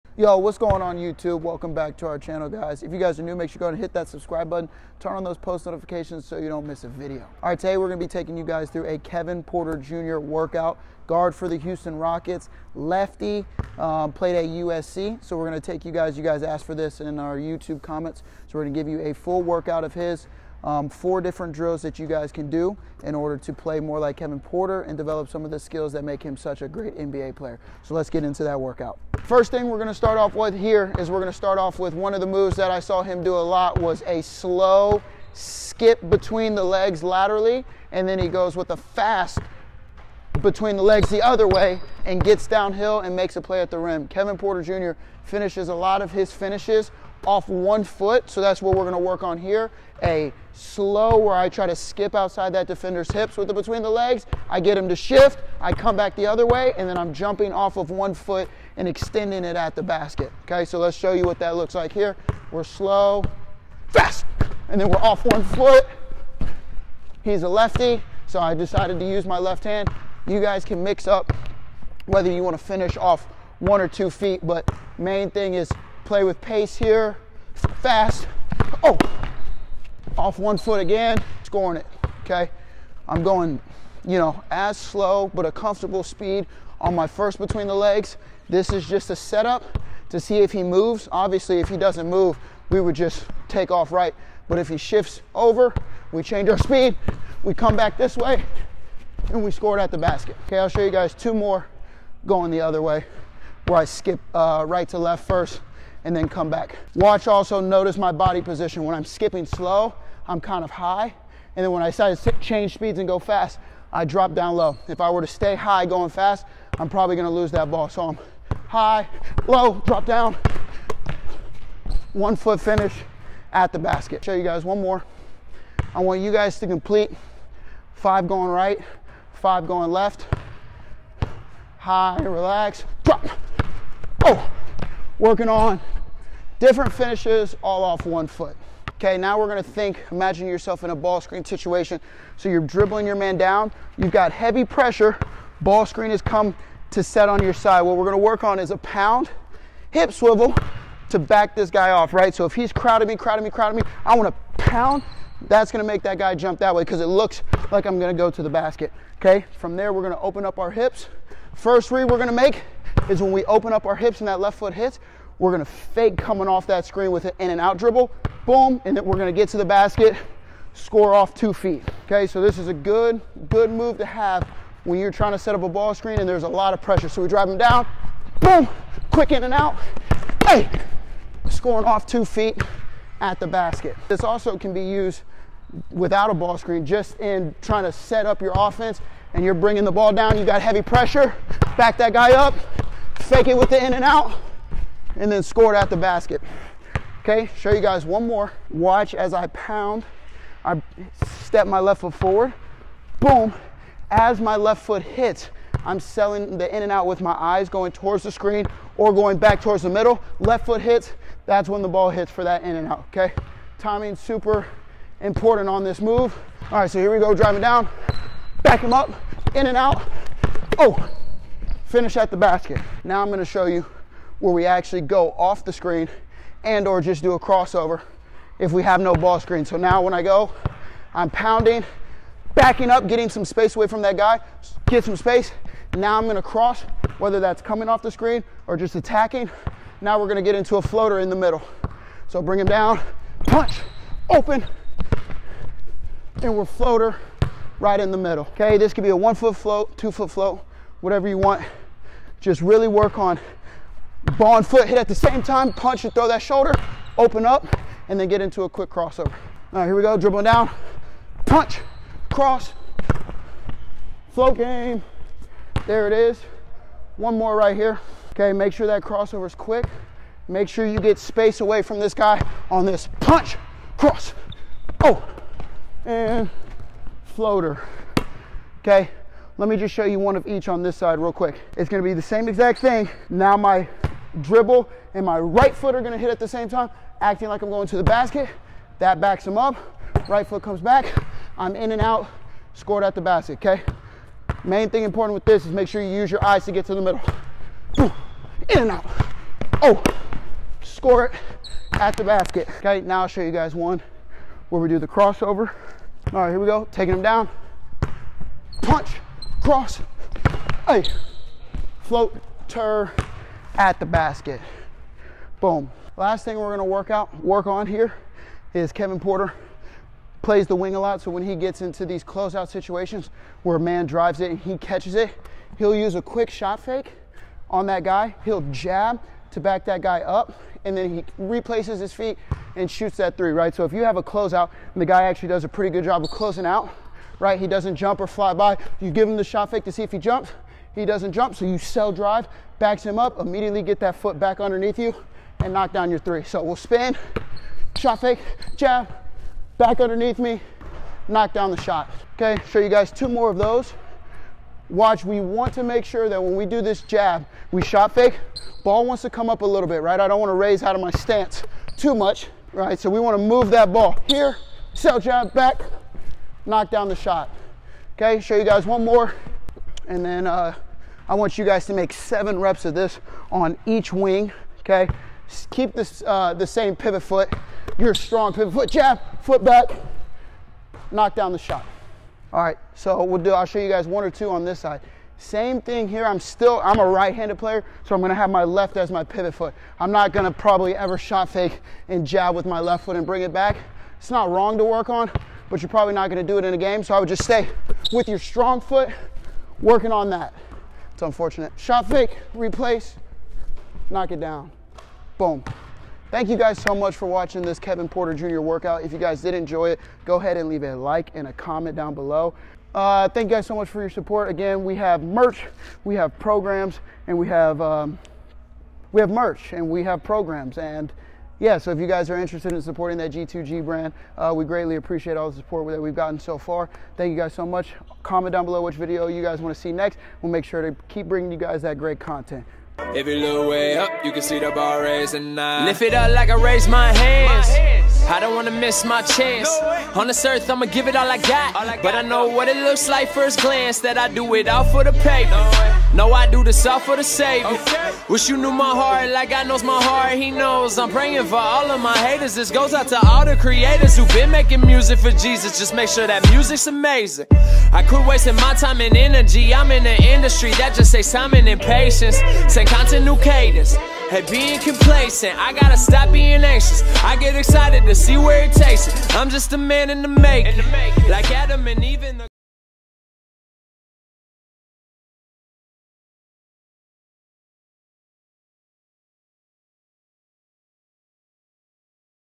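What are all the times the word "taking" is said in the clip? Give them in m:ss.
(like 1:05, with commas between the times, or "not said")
0:08, 5:06.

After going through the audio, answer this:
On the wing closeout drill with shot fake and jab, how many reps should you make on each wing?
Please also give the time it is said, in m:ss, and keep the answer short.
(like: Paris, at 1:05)
7, at 6:12.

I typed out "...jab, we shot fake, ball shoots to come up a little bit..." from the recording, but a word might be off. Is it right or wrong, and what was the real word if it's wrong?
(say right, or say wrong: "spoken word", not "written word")
wrong: "wants", not "shoots".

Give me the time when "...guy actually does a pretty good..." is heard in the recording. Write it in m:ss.
5:35.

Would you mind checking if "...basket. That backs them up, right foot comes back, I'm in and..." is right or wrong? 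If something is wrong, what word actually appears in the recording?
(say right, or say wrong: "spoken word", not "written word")
right.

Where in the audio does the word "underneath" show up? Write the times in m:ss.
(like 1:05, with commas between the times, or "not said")
5:44, 5:50.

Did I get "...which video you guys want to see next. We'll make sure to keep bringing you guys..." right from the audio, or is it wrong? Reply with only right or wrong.
right.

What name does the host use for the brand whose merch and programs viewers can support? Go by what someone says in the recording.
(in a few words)
G2G.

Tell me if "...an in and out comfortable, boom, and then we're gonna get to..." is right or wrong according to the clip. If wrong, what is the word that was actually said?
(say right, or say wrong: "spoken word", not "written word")
wrong: "dribble", not "comfortable".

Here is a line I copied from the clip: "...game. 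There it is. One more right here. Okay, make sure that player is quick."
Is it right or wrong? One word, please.
wrong.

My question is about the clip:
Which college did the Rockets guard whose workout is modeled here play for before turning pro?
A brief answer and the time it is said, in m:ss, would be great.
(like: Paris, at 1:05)
USC, at 0:14.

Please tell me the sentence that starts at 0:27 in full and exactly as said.
So let's get into that workout.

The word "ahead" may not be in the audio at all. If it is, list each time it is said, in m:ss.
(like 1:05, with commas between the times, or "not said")
6:50.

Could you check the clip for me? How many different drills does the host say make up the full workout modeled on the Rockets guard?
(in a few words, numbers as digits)
4.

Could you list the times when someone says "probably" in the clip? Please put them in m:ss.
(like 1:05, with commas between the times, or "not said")
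1:56, 6:30, 6:35.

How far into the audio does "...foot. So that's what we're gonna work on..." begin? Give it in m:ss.
0:47.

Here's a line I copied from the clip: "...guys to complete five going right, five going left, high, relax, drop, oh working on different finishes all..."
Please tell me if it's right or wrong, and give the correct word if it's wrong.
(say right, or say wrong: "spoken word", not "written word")
right.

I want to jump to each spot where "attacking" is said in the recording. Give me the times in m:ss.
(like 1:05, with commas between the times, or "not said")
3:58.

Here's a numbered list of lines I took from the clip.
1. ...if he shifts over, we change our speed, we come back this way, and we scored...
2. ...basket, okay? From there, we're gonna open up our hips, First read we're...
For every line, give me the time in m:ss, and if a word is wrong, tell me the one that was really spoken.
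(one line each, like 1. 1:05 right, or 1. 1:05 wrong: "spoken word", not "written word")
1. 1:34 right
2. 2:38 right.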